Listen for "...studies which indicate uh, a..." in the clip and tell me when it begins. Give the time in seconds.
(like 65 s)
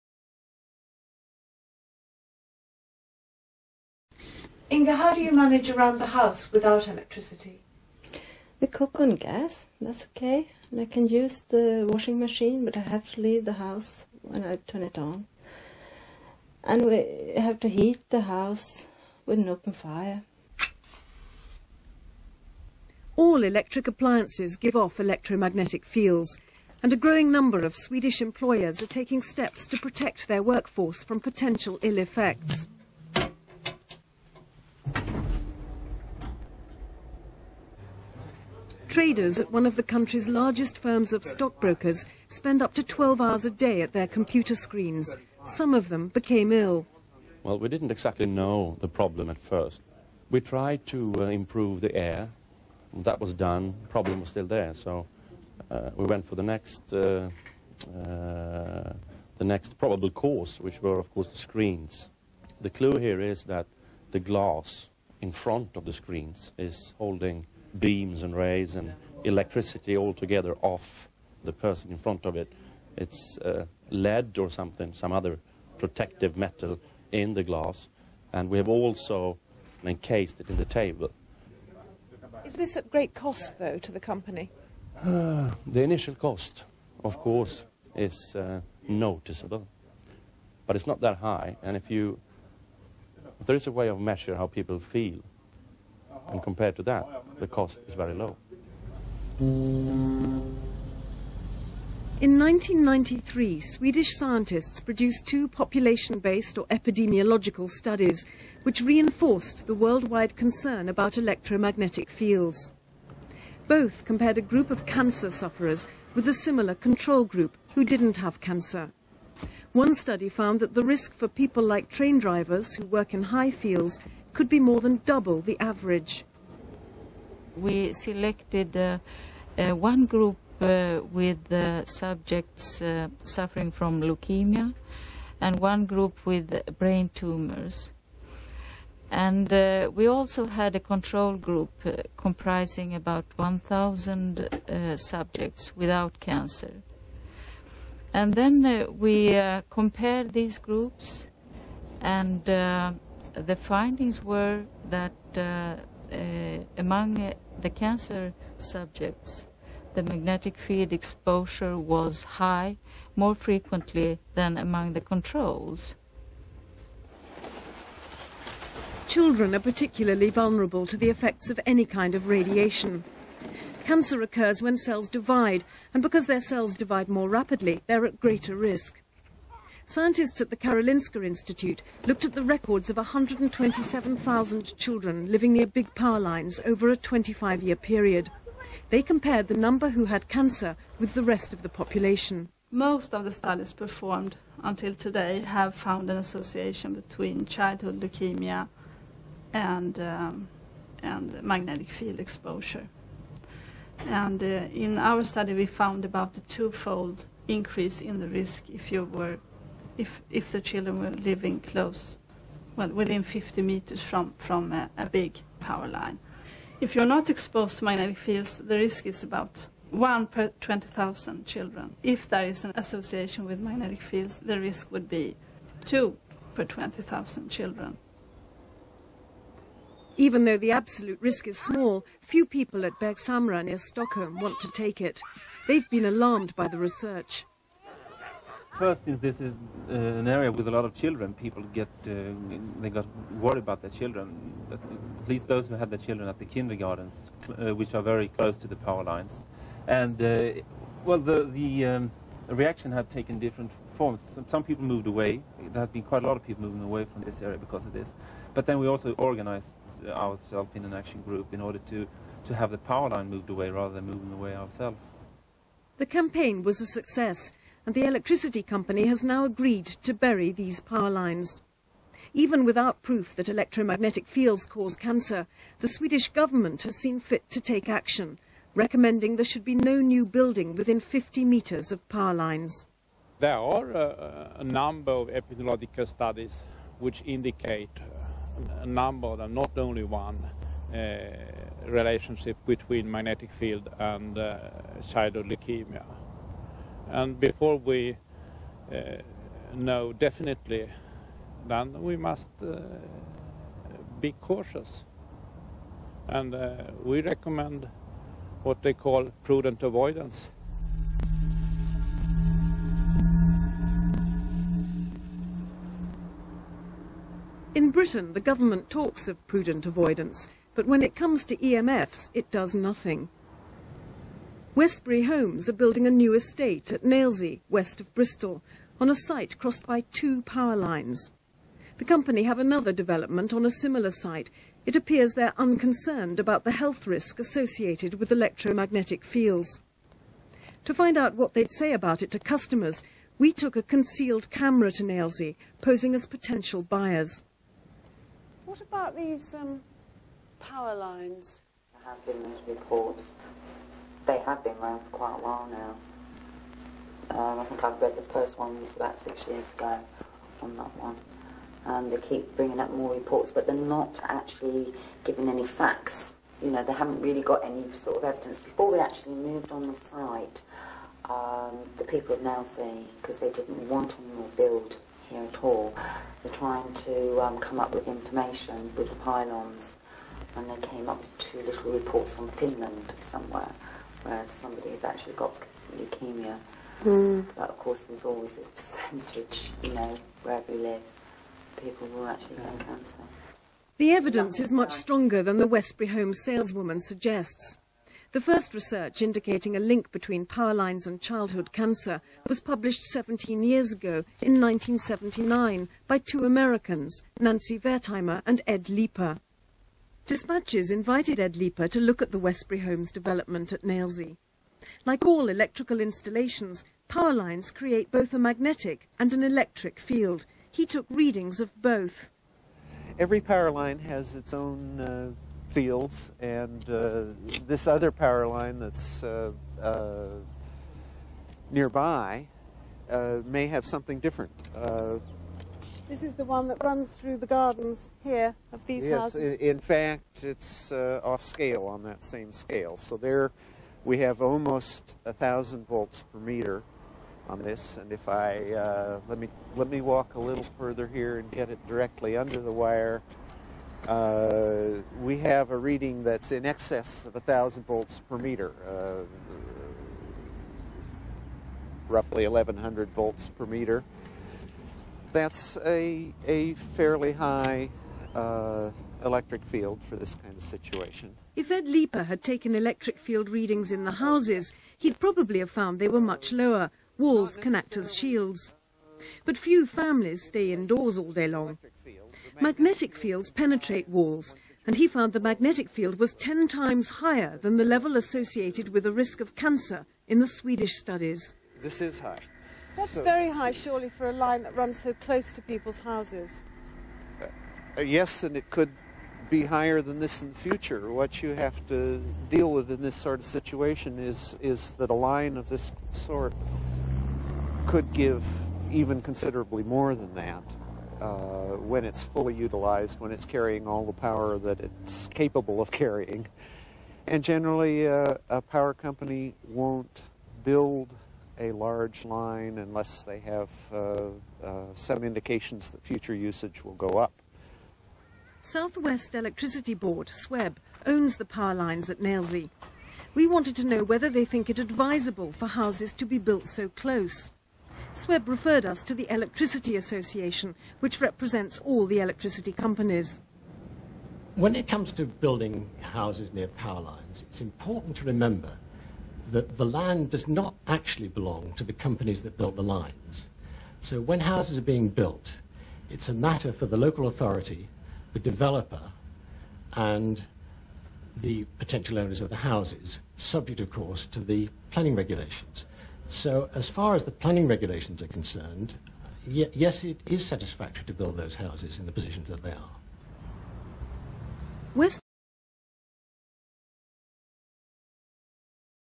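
286 s.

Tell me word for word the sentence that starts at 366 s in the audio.
You know, they haven't really got any sort of evidence.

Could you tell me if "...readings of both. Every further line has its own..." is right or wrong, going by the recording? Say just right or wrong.
wrong.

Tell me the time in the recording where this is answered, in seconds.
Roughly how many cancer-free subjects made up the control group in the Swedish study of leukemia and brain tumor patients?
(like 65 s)
143 s.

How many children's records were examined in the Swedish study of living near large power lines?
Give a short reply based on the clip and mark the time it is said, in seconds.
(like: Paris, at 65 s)
127,000, at 182 s.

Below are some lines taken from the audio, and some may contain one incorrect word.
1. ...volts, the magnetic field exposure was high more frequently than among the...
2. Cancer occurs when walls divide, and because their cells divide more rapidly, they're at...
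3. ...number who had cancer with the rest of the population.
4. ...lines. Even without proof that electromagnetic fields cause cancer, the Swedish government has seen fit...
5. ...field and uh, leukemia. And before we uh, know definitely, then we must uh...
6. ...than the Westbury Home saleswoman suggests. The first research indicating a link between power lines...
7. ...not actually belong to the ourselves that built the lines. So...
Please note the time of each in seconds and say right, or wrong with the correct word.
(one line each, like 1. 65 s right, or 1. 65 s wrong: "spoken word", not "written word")
1. 158 s wrong: "subjects", not "volts"
2. 173 s wrong: "cells", not "walls"
3. 189 s right
4. 271 s right
5. 293 s right
6. 395 s right
7. 550 s wrong: "companies", not "ourselves".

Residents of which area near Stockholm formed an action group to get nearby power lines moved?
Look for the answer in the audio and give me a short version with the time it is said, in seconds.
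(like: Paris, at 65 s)
Bergshamra, at 232 s.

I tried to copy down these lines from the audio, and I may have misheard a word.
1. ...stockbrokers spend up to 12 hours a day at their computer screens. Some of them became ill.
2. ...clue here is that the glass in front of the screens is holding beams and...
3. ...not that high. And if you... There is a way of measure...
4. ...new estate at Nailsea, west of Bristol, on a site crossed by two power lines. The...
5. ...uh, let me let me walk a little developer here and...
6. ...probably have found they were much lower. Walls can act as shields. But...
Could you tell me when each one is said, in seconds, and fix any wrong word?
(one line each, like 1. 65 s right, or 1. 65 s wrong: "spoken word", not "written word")
1. 41 s right
2. 62 s right
3. 90 s right
4. 326 s right
5. 448 s wrong: "further", not "developer"
6. 475 s right.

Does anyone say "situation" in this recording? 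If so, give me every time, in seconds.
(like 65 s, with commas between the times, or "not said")
470 s, 503 s.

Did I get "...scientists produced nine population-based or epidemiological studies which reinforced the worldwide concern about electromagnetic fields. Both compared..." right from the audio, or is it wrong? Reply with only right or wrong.
wrong.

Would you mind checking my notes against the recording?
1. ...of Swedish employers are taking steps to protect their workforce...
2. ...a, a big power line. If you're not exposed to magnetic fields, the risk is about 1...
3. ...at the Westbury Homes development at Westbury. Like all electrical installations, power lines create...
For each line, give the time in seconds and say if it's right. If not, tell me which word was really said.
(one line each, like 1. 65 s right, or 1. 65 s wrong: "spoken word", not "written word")
1. 27 s right
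2. 214 s right
3. 412 s wrong: "Nailsea", not "Westbury".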